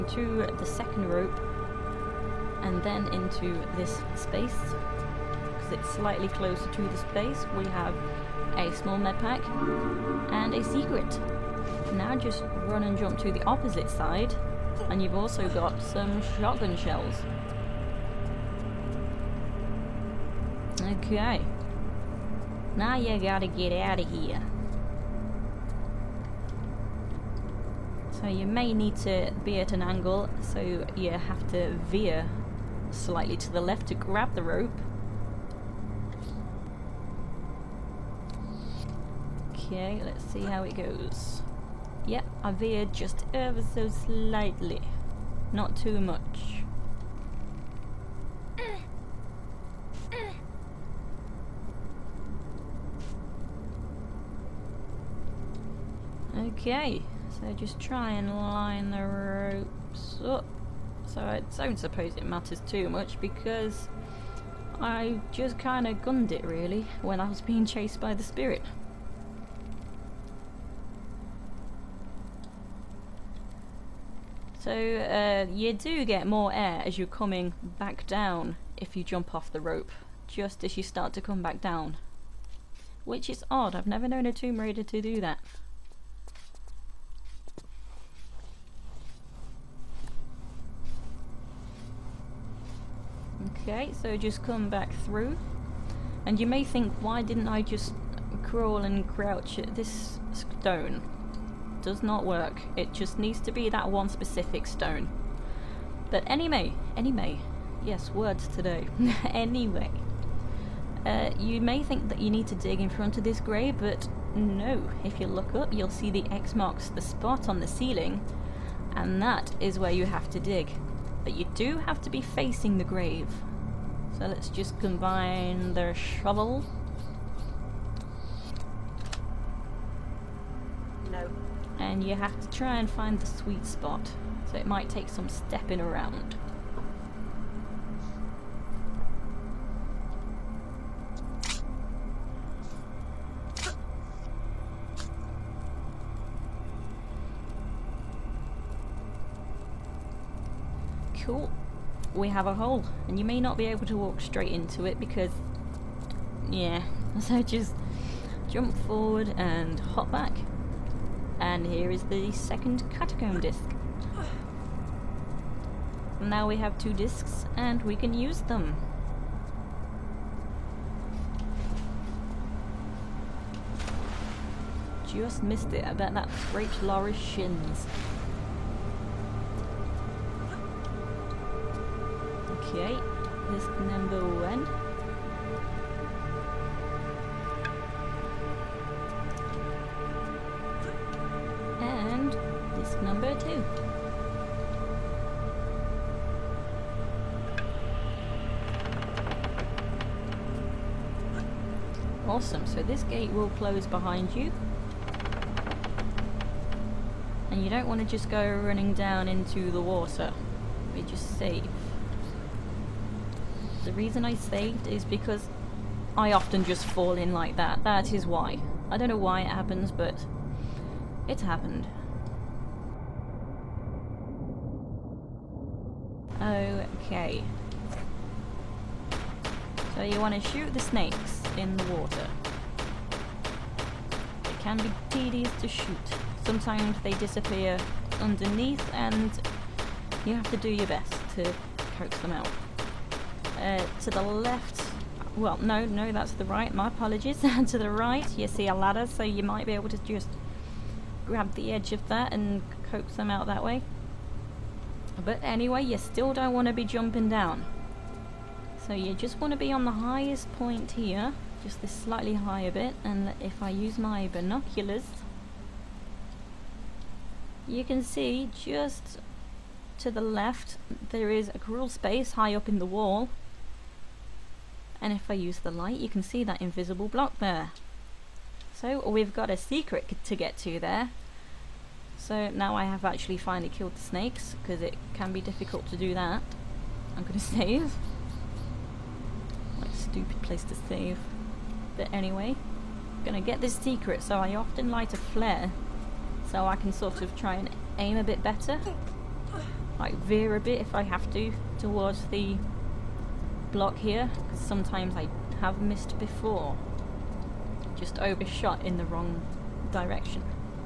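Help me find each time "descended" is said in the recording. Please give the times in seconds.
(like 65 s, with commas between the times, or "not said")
not said.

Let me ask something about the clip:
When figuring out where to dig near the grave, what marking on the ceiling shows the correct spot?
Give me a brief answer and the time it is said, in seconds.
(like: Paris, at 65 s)
X marks the spot, at 116 s.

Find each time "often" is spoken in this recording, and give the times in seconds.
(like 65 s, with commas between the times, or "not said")
216 s, 294 s.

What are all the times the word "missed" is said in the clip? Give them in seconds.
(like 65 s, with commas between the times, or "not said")
175 s, 305 s.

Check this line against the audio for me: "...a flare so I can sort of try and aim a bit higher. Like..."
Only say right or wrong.
wrong.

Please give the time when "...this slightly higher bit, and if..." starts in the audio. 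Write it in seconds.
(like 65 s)
261 s.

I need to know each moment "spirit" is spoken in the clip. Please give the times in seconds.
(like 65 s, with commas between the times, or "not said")
68 s.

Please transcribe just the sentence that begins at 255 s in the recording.
But anyway, you still don't want to be jumping down.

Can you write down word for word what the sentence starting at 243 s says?
Uh, to the left, well no, no that's the right, my apologies.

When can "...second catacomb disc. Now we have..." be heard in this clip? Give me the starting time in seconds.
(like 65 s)
162 s.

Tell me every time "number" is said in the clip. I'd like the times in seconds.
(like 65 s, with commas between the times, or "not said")
183 s, 193 s.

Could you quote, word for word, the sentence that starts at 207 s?
And you don't want to just go running down into the water.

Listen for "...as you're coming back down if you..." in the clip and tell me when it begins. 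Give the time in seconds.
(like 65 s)
76 s.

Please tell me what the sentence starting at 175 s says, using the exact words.
I bet that scraped Lara's shins.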